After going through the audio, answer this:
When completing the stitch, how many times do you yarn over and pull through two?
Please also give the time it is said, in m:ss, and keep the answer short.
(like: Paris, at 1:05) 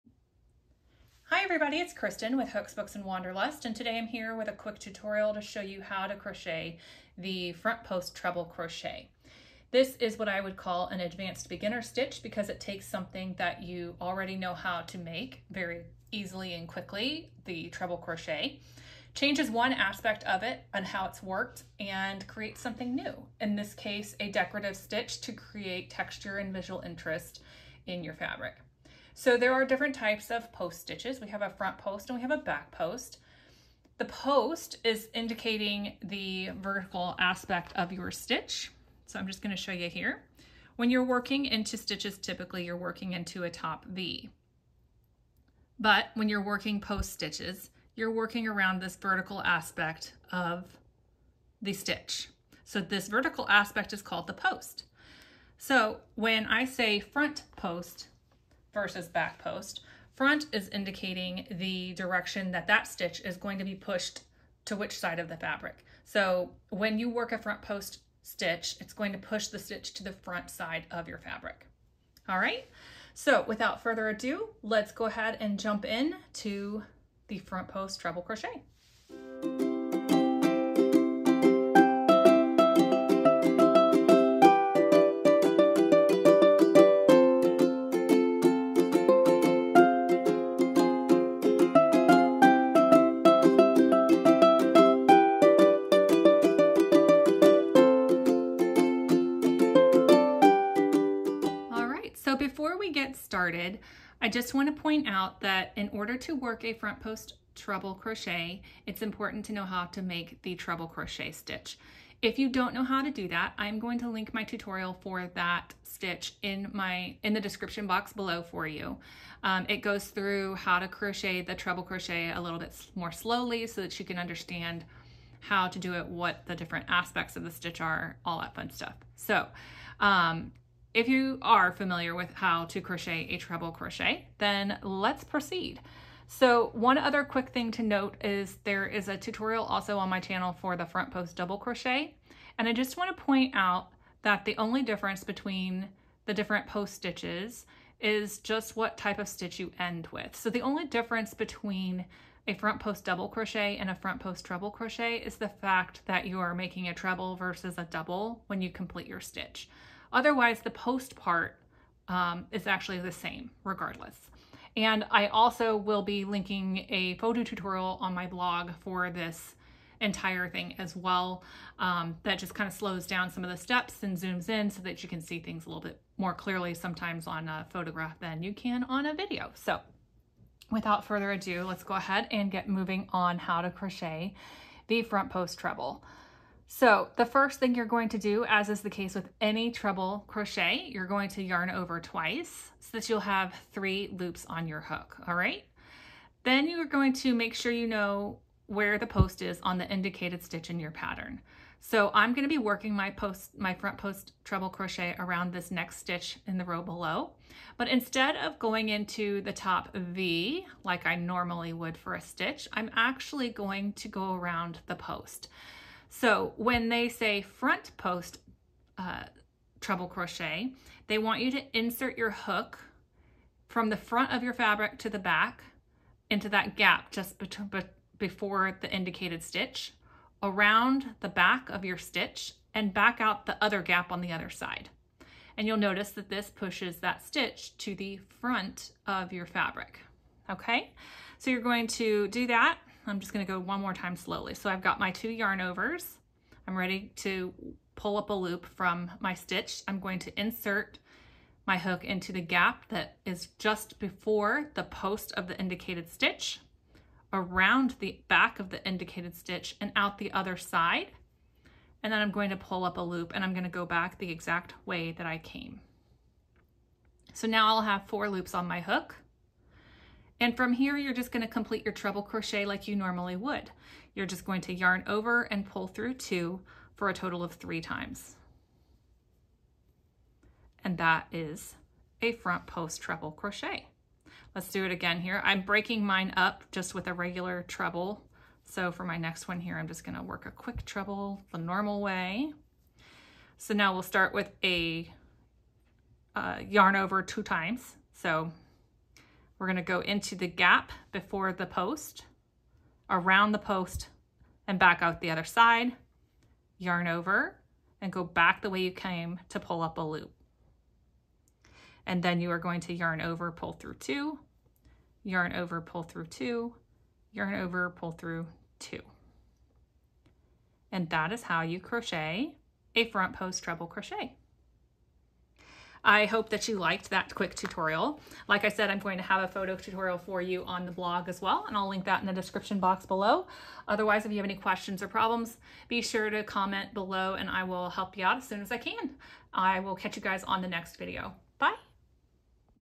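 3, at 4:37.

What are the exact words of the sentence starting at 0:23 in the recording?
In this case, a decorative stitch to create texture and visual interest in your fabric.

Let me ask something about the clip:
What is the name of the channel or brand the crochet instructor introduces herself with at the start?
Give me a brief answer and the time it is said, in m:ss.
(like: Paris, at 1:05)
Hooks, Books, and Wanderlust, at 0:02.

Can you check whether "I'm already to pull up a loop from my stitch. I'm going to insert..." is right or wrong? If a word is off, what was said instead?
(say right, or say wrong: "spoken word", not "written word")
wrong: "ready", not "already".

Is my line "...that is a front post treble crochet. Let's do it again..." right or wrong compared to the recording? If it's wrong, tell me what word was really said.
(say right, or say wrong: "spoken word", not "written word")
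right.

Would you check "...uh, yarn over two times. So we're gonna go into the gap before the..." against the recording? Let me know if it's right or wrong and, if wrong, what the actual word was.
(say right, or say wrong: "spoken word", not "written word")
right.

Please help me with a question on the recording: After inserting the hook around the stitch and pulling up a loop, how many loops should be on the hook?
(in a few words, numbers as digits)
4.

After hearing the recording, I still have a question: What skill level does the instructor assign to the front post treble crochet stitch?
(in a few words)
advanced beginner.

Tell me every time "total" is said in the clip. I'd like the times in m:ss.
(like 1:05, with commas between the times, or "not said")
4:37.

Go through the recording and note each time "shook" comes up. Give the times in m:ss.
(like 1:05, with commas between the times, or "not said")
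not said.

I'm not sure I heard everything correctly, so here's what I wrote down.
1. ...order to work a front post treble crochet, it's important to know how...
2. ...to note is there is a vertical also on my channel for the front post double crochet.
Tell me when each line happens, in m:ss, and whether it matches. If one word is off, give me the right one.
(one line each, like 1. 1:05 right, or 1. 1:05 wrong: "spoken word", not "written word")
1. 1:45 right
2. 2:17 wrong: "tutorial", not "vertical".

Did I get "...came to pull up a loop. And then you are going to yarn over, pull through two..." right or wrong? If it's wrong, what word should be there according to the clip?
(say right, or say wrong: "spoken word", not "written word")
right.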